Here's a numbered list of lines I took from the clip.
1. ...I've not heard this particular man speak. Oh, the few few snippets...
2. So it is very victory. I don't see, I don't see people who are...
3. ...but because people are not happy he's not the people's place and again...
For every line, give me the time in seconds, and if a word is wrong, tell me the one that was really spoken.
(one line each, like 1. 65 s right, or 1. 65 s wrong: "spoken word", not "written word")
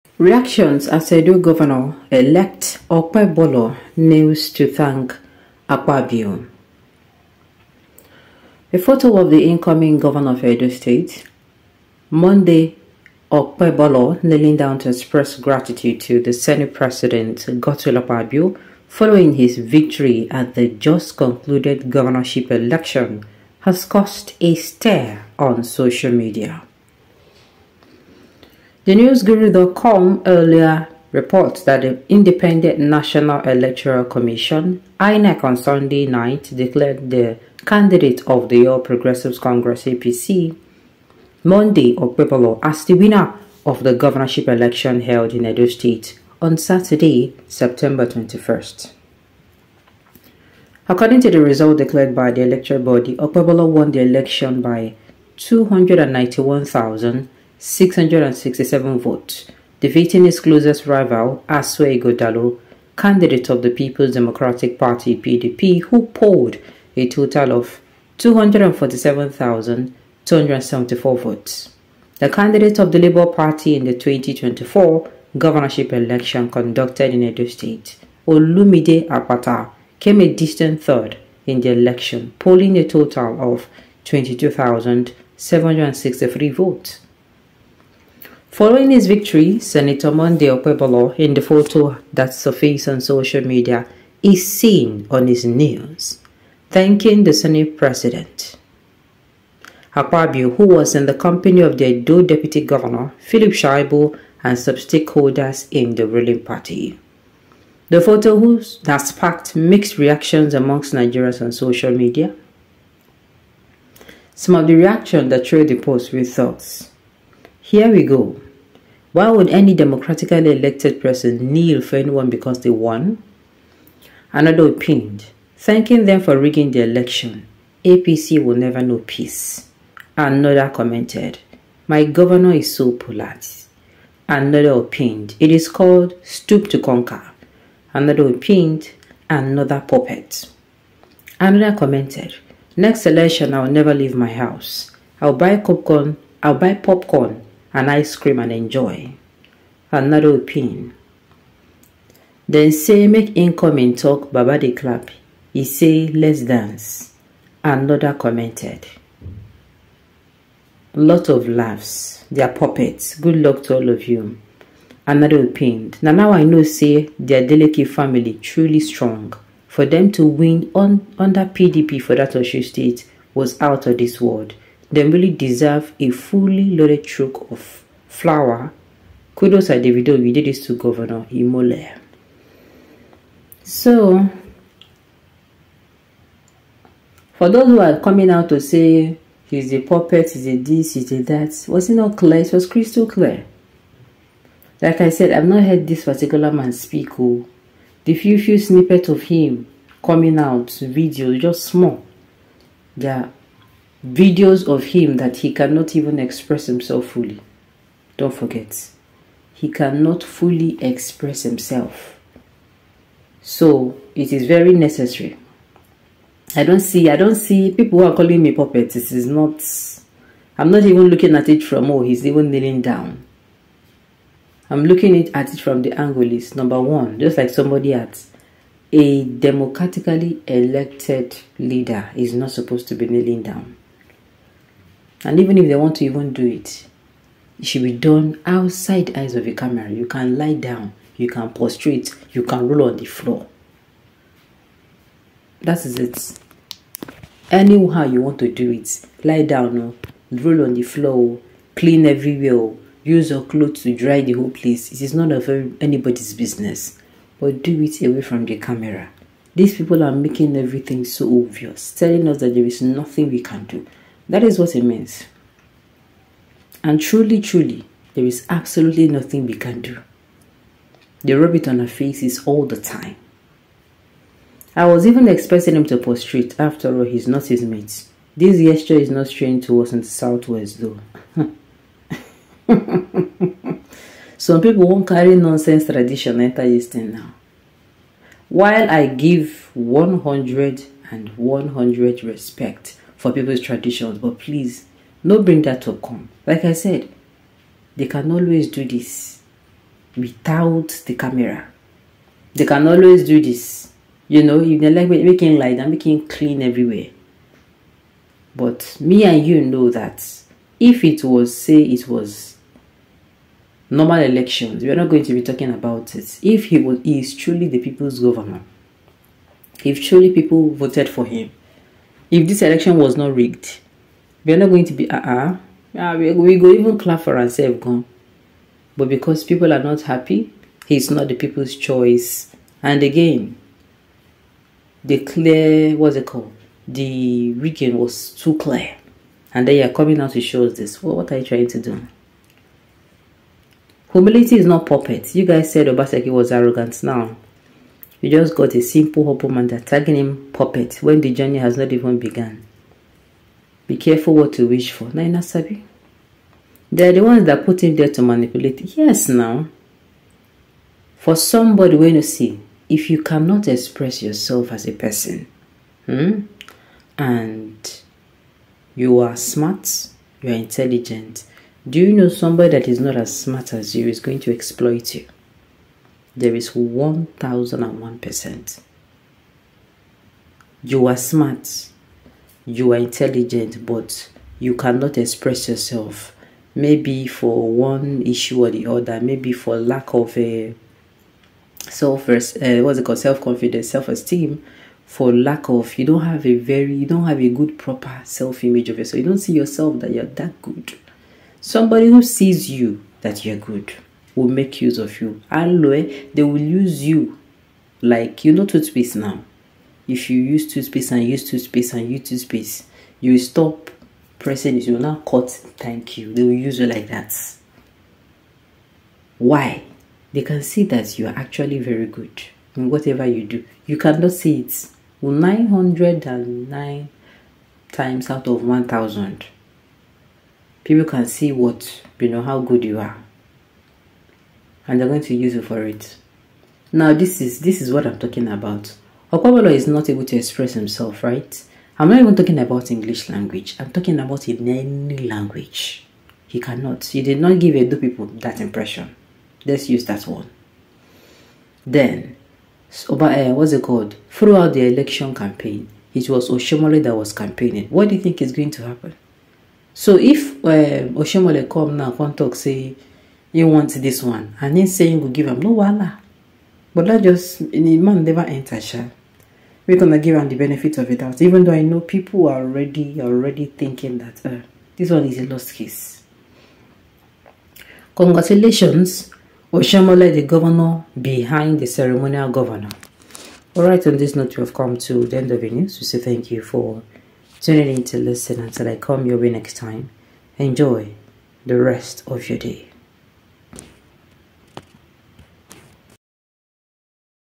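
1. 195 s right
2. 213 s wrong: "necessary", not "victory"
3. 328 s wrong: "choice", not "place".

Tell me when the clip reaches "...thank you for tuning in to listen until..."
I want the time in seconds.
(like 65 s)
486 s.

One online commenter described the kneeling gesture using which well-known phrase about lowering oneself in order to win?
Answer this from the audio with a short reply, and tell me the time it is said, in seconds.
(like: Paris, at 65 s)
stoop to conquer, at 136 s.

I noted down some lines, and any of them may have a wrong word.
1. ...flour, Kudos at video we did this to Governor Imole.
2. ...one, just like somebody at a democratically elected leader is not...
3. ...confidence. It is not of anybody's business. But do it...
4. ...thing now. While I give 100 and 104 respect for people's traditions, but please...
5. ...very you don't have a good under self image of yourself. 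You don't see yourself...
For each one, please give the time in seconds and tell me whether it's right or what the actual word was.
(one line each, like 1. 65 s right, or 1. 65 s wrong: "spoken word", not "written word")
1. 178 s right
2. 226 s right
3. 254 s wrong: "place", not "confidence"
4. 286 s wrong: "100", not "104"
5. 396 s wrong: "proper", not "under".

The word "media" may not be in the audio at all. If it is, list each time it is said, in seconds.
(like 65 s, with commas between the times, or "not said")
26 s, 93 s, 111 s.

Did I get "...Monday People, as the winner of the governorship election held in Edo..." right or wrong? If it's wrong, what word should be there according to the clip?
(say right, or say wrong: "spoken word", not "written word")
wrong: "Okpebolo", not "People".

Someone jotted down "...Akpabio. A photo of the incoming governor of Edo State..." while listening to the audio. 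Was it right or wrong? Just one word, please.
right.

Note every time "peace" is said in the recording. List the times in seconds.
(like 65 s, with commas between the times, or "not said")
129 s.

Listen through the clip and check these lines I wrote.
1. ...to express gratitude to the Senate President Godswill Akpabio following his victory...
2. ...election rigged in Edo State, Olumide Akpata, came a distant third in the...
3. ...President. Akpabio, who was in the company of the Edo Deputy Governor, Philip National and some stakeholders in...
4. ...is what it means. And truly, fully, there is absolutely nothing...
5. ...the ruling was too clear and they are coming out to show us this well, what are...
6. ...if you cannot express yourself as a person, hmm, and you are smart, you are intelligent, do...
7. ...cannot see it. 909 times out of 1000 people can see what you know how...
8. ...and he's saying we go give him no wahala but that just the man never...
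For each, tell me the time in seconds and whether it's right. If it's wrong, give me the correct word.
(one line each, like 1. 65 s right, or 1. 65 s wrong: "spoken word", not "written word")
1. 14 s right
2. 75 s wrong: "conducted", not "rigged"
3. 97 s wrong: "Shaibu", not "National"
4. 264 s wrong: "truly", not "fully"
5. 336 s wrong: "rigging", not "ruling"
6. 362 s right
7. 423 s right
8. 464 s right.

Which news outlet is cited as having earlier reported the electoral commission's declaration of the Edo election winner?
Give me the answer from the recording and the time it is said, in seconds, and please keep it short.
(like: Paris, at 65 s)
newsguru.com, at 28 s.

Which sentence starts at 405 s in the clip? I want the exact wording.
Aloe, they will use you like you know toothpaste now.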